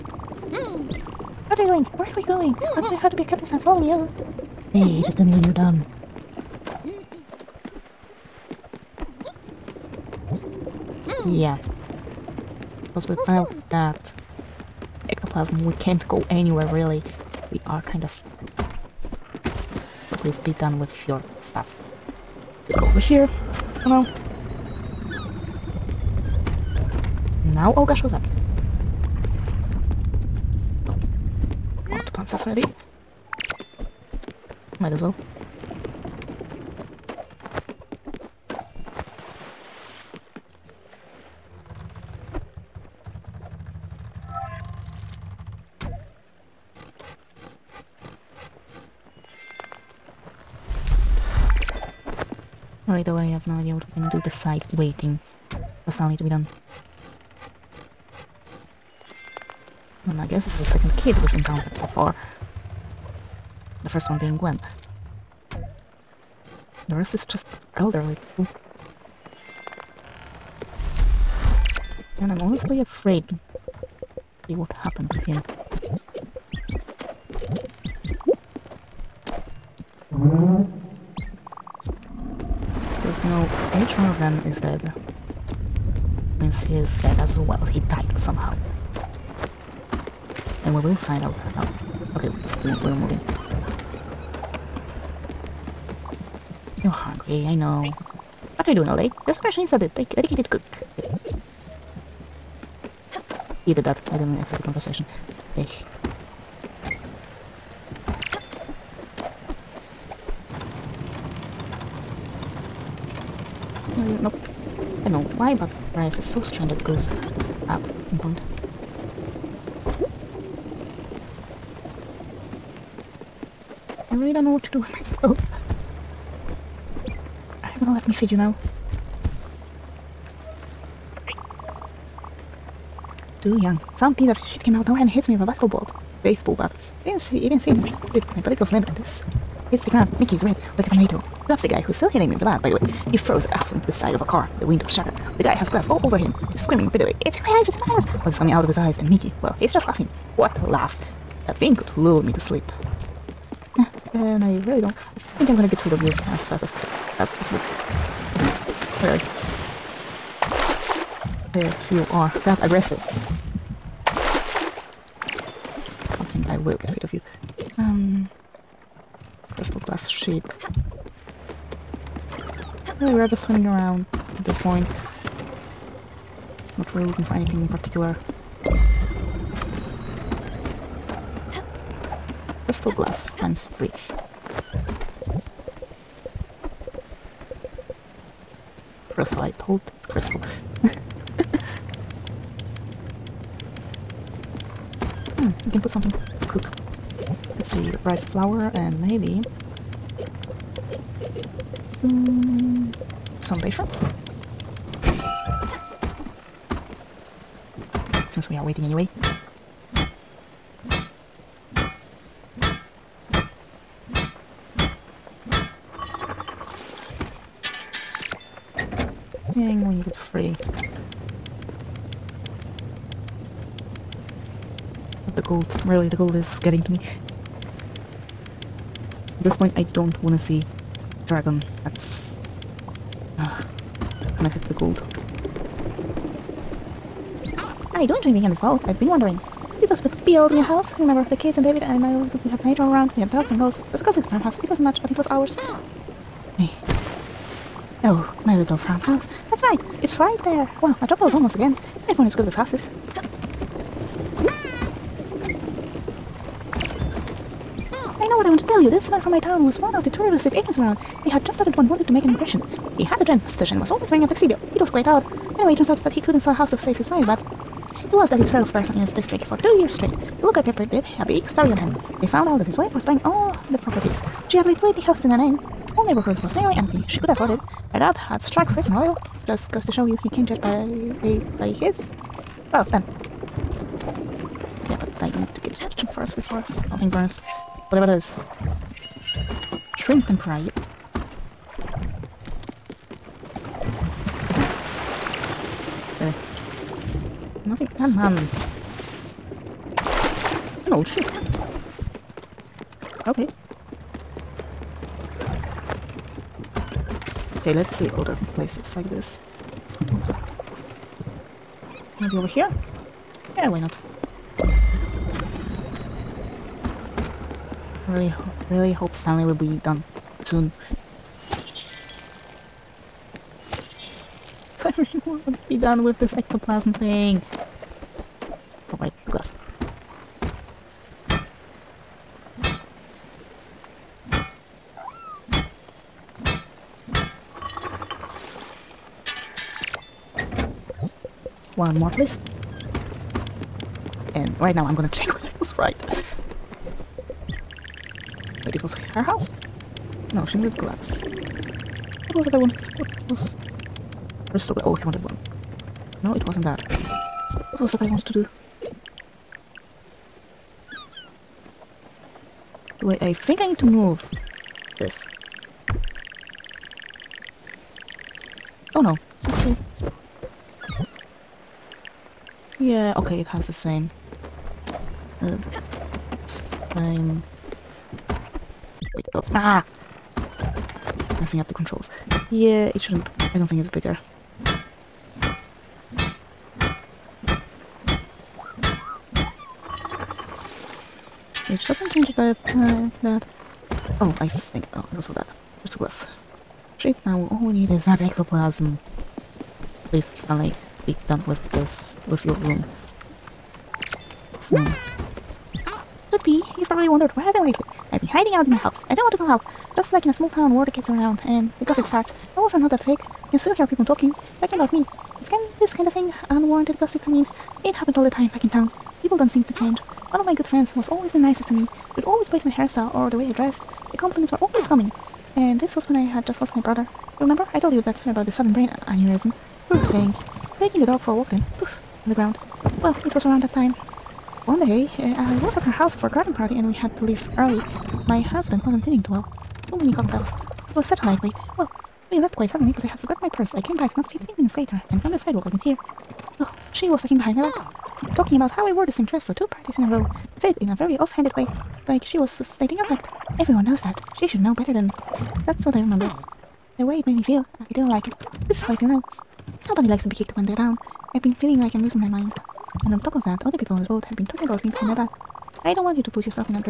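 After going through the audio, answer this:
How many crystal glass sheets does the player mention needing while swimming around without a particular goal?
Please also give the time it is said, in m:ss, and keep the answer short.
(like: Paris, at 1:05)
3, at 3:03.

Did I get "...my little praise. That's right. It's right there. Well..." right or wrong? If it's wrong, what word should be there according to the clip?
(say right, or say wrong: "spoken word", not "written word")
wrong: "farmhouse", not "praise".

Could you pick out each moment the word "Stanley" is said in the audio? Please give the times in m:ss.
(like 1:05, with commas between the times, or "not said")
0:55, 5:19, 6:40.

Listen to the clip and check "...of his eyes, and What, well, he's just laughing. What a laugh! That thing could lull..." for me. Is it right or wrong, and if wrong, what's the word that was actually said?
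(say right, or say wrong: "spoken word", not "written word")
wrong: "Mickey", not "What".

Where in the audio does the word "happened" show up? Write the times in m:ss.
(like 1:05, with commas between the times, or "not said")
1:14, 6:57.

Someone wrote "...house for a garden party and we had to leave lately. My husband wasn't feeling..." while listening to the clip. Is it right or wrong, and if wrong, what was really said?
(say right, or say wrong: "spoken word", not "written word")
wrong: "early", not "lately".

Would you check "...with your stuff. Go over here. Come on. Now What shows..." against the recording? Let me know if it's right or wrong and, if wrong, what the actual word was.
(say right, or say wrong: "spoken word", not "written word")
wrong: "Olga", not "What".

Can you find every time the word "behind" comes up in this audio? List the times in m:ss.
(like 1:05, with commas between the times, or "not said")
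7:27, 7:44.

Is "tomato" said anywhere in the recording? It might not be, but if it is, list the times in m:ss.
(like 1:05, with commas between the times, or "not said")
2:20.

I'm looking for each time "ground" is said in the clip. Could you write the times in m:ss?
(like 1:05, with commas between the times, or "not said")
2:19, 7:12.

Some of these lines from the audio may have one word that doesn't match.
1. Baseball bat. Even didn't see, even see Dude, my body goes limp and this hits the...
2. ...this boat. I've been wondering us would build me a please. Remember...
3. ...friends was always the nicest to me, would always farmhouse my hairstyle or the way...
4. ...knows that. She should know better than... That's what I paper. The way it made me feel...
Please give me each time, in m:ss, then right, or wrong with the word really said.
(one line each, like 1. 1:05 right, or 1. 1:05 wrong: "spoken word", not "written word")
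1. 2:16 right
2. 3:58 wrong: "house", not "please"
3. 7:00 wrong: "praise", not "farmhouse"
4. 7:33 wrong: "remember", not "paper".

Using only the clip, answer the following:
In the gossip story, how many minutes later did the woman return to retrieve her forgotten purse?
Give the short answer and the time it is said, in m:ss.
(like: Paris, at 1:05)
15, at 7:24.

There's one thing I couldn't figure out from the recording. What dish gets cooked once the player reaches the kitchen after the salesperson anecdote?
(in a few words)
Shrimp tempura.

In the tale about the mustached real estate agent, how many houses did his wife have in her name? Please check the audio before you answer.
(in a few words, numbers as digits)
20.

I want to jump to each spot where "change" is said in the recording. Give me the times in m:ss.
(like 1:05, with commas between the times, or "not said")
6:32, 6:59.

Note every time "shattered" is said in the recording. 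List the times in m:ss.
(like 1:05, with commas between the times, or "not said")
2:24.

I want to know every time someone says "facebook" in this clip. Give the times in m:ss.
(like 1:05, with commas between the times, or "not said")
not said.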